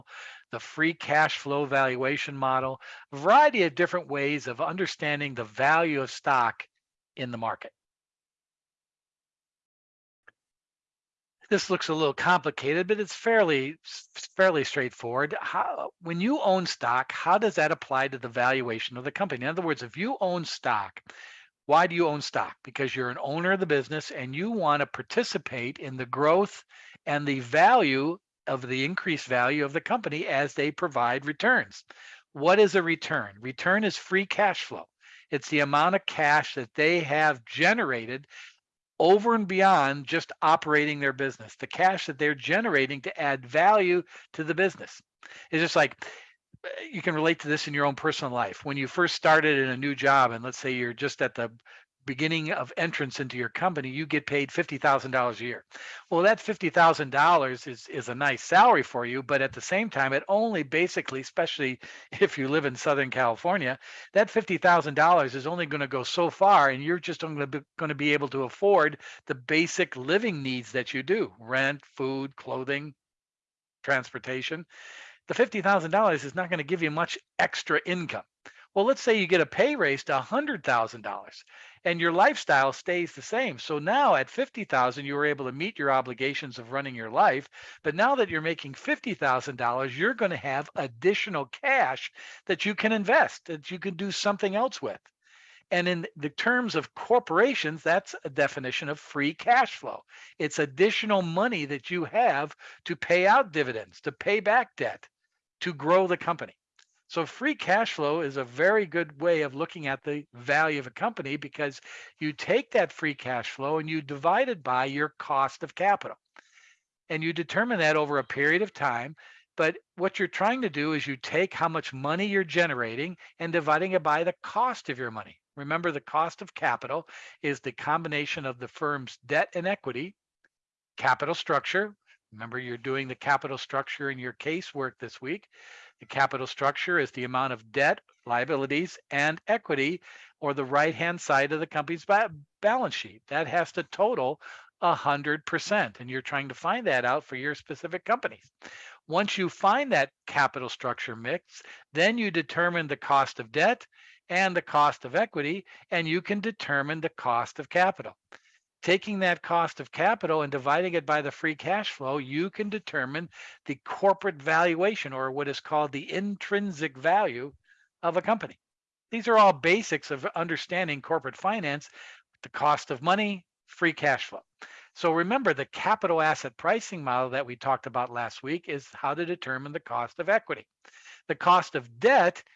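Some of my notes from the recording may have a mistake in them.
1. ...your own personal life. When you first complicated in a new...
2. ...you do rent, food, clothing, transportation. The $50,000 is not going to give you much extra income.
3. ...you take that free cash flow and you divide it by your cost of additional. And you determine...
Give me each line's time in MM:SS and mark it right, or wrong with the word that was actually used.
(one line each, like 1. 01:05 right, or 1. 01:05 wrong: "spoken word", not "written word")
1. 00:47 wrong: "started", not "complicated"
2. 01:10 right
3. 01:52 wrong: "capital", not "additional".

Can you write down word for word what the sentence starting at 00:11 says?
This looks a little complicated, but it's fairly fairly straightforward.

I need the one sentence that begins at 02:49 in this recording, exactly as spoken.
These are all basics of understanding corporate finance, the cost of money, free cash flow.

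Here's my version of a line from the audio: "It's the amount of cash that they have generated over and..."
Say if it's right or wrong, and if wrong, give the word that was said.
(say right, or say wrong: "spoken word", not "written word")
right.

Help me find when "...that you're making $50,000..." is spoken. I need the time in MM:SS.
01:28.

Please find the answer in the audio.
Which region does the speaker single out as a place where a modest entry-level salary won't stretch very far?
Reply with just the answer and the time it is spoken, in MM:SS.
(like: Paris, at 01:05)
Southern California, at 01:02.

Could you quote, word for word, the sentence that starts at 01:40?
It's additional money that you have to pay out dividends, to pay back debt, to grow the company.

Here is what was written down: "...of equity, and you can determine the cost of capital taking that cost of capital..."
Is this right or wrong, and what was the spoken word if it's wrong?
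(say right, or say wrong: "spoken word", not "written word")
right.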